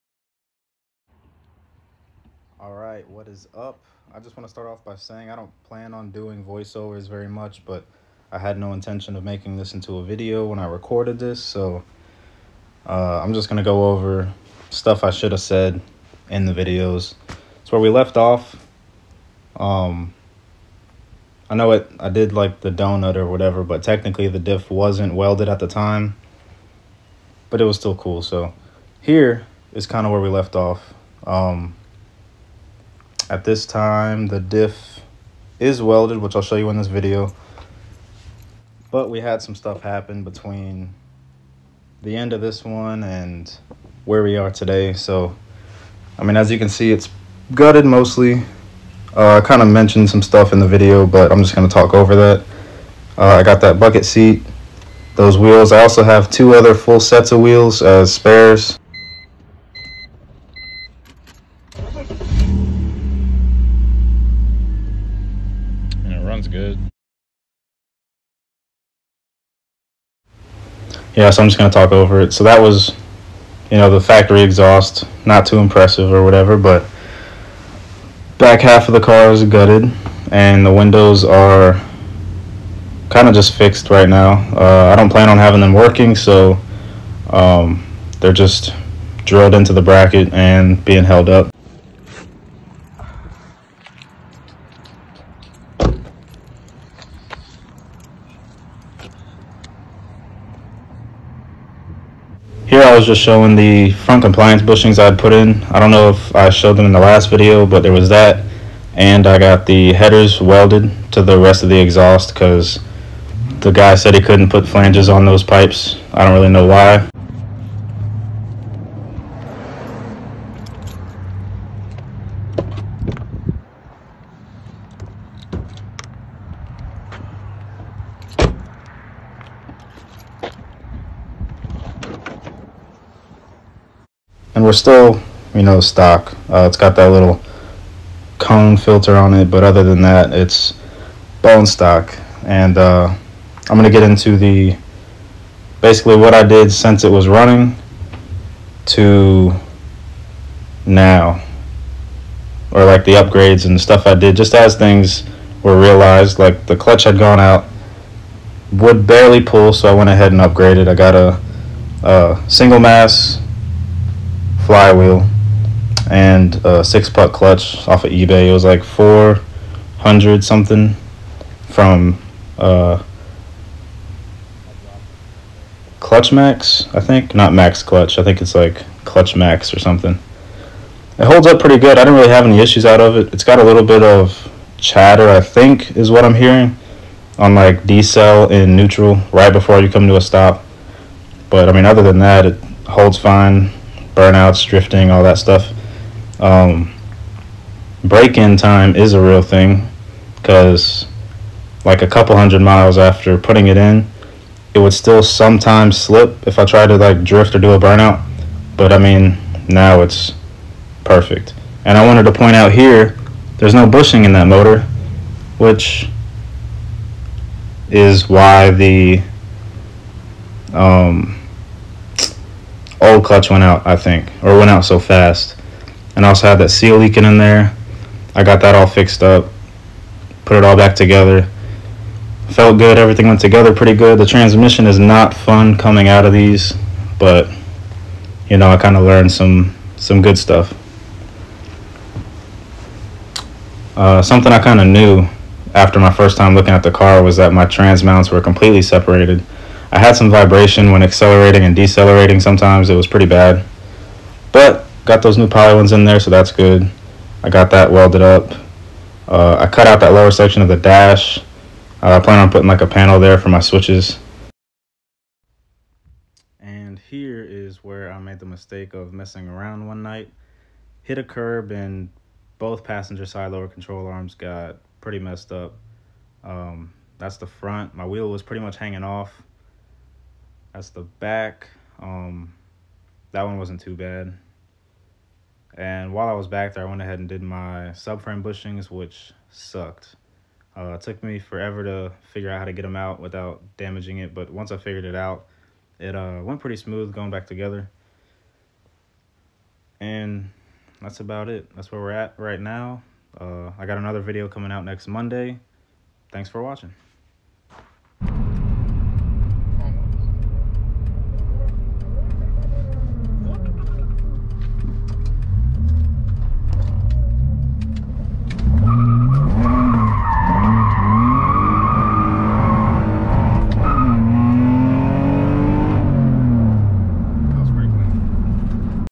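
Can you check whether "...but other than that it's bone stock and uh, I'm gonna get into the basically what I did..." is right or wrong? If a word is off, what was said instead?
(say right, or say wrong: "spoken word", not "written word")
right.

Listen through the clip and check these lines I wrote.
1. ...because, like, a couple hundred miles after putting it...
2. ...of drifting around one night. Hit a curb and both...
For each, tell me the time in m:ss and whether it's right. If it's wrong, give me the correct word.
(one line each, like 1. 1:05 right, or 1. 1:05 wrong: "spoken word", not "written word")
1. 3:20 right
2. 4:28 wrong: "messing", not "drifting".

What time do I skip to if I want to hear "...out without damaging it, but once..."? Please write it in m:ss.
4:52.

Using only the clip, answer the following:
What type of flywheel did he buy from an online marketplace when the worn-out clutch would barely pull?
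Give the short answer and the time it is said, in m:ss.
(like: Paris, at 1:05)
single mass, at 2:42.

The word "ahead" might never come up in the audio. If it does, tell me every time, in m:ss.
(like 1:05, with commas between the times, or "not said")
2:40, 4:47.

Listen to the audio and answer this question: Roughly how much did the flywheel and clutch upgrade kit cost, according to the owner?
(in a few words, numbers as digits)
400 something.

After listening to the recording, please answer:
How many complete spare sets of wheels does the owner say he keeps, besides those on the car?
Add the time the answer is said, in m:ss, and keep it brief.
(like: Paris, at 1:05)
2, at 0:56.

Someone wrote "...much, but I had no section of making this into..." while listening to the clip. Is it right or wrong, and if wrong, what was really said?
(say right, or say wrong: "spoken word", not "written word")
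wrong: "intention", not "section".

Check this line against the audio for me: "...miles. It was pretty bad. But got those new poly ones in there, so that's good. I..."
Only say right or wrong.
wrong.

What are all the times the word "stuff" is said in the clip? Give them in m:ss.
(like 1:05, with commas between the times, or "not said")
0:14, 0:39, 0:50, 2:33, 3:15, 4:00.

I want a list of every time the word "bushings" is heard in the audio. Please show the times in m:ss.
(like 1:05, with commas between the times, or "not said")
1:44, 3:33, 4:48.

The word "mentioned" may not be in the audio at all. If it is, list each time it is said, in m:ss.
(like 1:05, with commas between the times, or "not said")
0:49.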